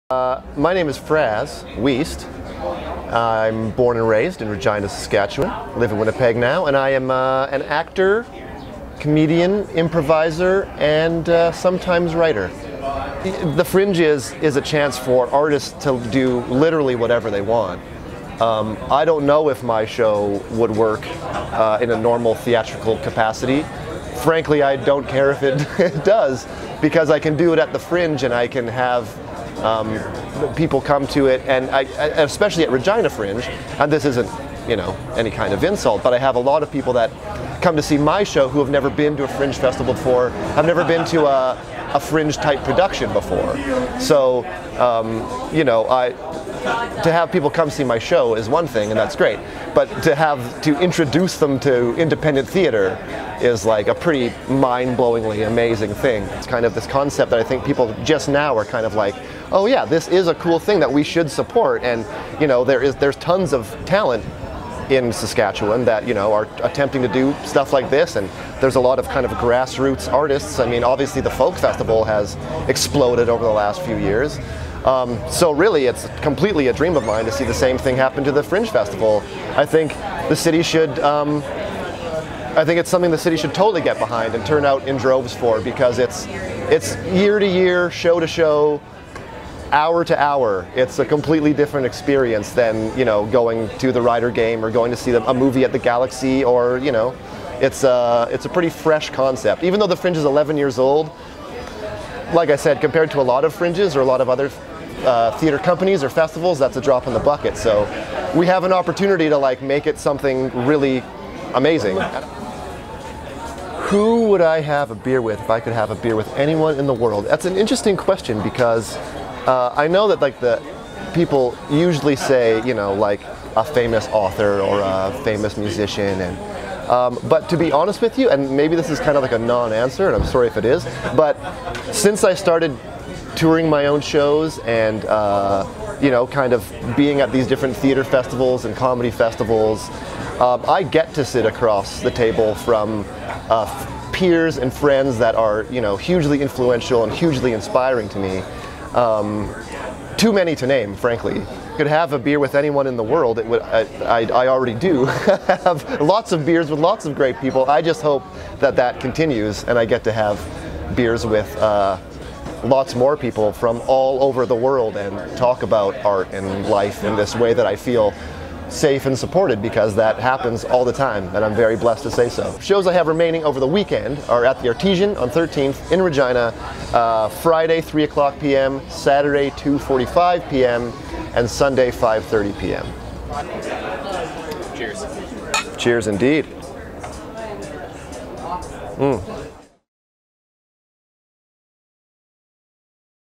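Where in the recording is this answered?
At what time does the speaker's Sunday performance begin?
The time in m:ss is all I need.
3:01.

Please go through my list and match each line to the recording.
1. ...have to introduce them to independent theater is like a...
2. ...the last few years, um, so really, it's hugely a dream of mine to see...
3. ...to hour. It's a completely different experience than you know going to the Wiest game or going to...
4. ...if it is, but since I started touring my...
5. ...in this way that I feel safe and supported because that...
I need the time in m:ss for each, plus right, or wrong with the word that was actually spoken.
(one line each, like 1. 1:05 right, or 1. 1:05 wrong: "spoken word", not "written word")
1. 0:50 right
2. 1:13 wrong: "completely", not "hugely"
3. 1:30 wrong: "Rider", not "Wiest"
4. 2:10 right
5. 2:47 right.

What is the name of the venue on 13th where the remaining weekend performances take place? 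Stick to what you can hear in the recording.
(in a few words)
Artesian.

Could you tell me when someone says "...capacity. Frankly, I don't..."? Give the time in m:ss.
0:22.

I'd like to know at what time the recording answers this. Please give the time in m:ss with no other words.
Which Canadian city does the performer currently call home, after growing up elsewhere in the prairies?
0:05.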